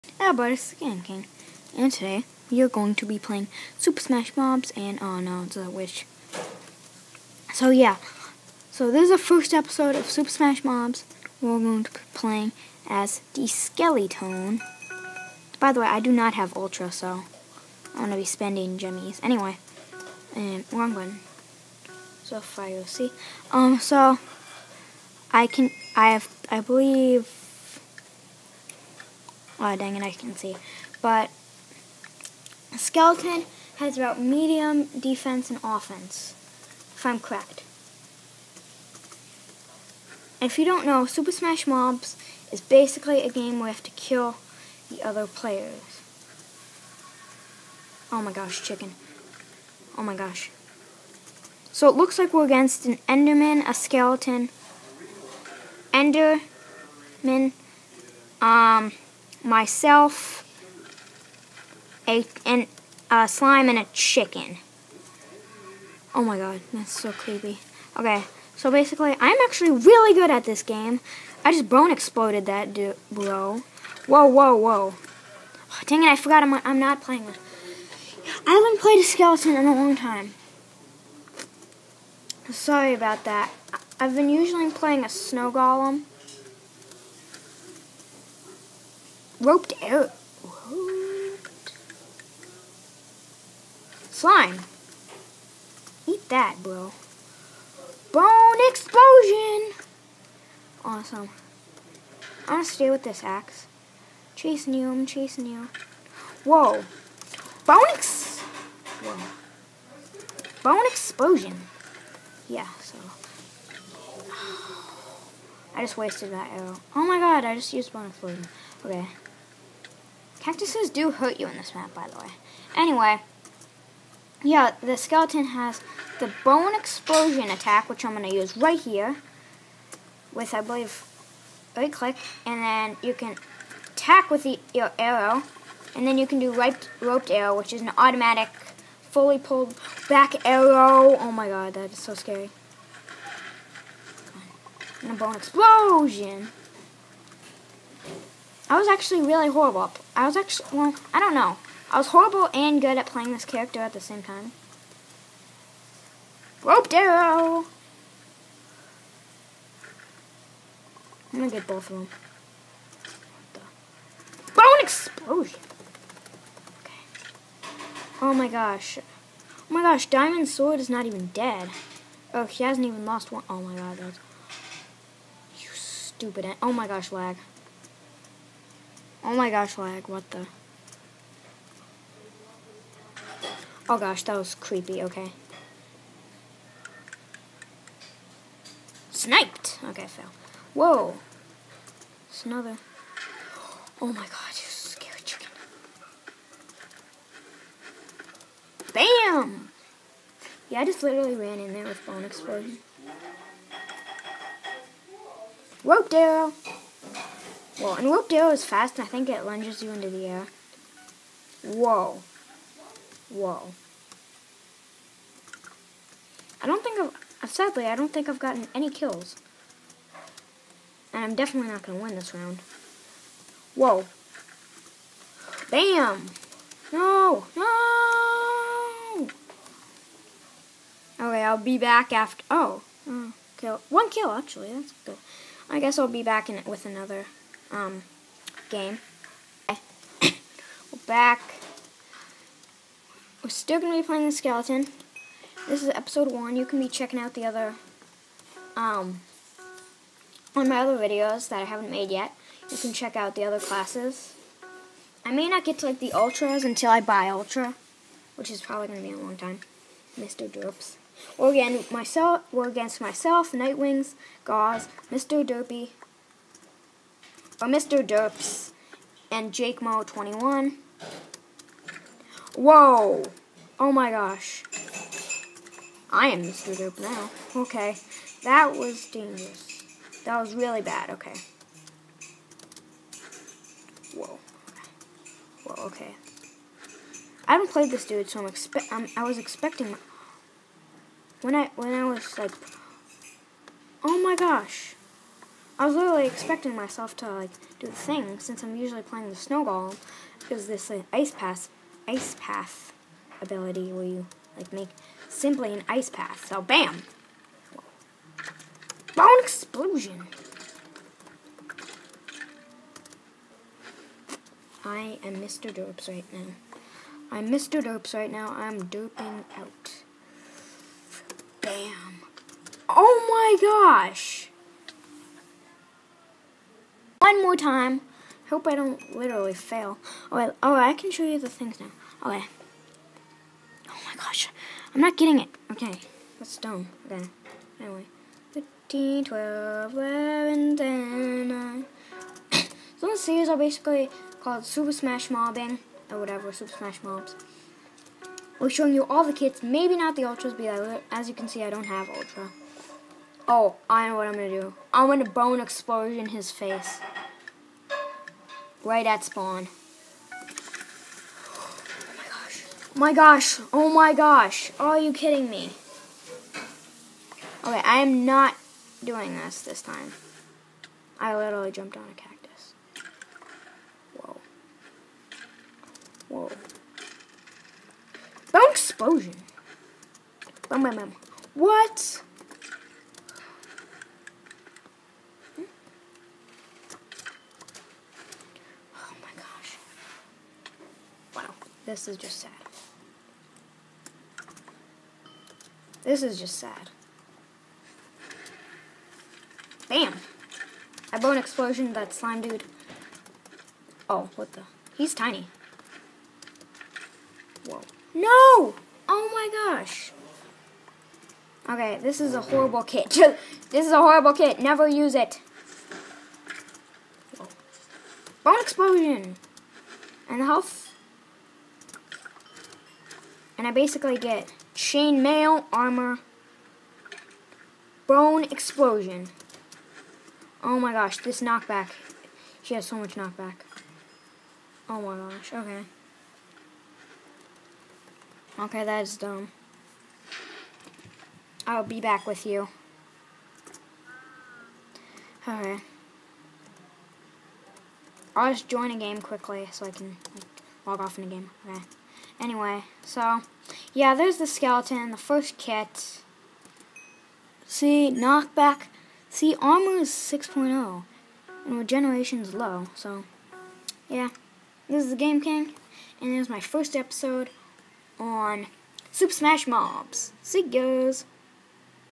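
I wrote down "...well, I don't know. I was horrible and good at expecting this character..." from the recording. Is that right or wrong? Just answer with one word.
wrong.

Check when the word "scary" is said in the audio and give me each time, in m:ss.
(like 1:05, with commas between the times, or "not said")
2:22, 3:14.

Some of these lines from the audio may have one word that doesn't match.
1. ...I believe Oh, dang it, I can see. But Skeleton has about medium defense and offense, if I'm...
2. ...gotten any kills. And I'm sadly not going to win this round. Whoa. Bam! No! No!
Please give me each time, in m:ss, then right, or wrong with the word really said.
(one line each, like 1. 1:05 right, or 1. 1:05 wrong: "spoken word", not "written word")
1. 0:26 right
2. 3:38 wrong: "definitely", not "sadly".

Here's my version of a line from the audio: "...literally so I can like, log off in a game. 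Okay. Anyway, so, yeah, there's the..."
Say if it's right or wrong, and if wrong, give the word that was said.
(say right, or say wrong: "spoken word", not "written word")
wrong: "quickly", not "literally".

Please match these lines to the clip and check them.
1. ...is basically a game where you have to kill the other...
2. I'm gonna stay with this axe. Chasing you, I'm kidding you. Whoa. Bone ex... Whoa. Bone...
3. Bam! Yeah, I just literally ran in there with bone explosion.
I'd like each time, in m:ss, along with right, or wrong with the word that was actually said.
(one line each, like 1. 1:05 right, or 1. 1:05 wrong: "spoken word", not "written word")
1. 0:42 right
2. 1:42 wrong: "chasing", not "kidding"
3. 3:18 right.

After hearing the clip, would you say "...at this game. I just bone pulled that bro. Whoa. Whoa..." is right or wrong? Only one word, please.
wrong.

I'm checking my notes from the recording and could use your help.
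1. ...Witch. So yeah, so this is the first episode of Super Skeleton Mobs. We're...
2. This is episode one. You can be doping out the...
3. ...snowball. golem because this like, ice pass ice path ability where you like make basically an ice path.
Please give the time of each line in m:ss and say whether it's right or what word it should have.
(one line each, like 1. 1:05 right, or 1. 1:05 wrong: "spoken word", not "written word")
1. 0:05 wrong: "Smash", not "Skeleton"
2. 4:05 wrong: "checking", not "doping"
3. 4:59 wrong: "simply", not "basically".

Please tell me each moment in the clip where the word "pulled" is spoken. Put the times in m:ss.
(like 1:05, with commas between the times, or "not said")
2:19.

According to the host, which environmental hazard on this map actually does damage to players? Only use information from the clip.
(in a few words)
Cactuses.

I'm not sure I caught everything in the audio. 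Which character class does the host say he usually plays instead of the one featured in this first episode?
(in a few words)
Snow golem.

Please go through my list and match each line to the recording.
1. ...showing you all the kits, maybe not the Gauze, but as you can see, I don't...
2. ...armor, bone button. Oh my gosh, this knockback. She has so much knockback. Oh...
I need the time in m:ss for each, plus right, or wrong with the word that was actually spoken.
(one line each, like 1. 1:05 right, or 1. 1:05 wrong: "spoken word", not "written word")
1. 5:48 wrong: "Ultras", not "Gauze"
2. 7:05 wrong: "explosion", not "button".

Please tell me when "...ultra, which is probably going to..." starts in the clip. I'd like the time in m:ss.
4:17.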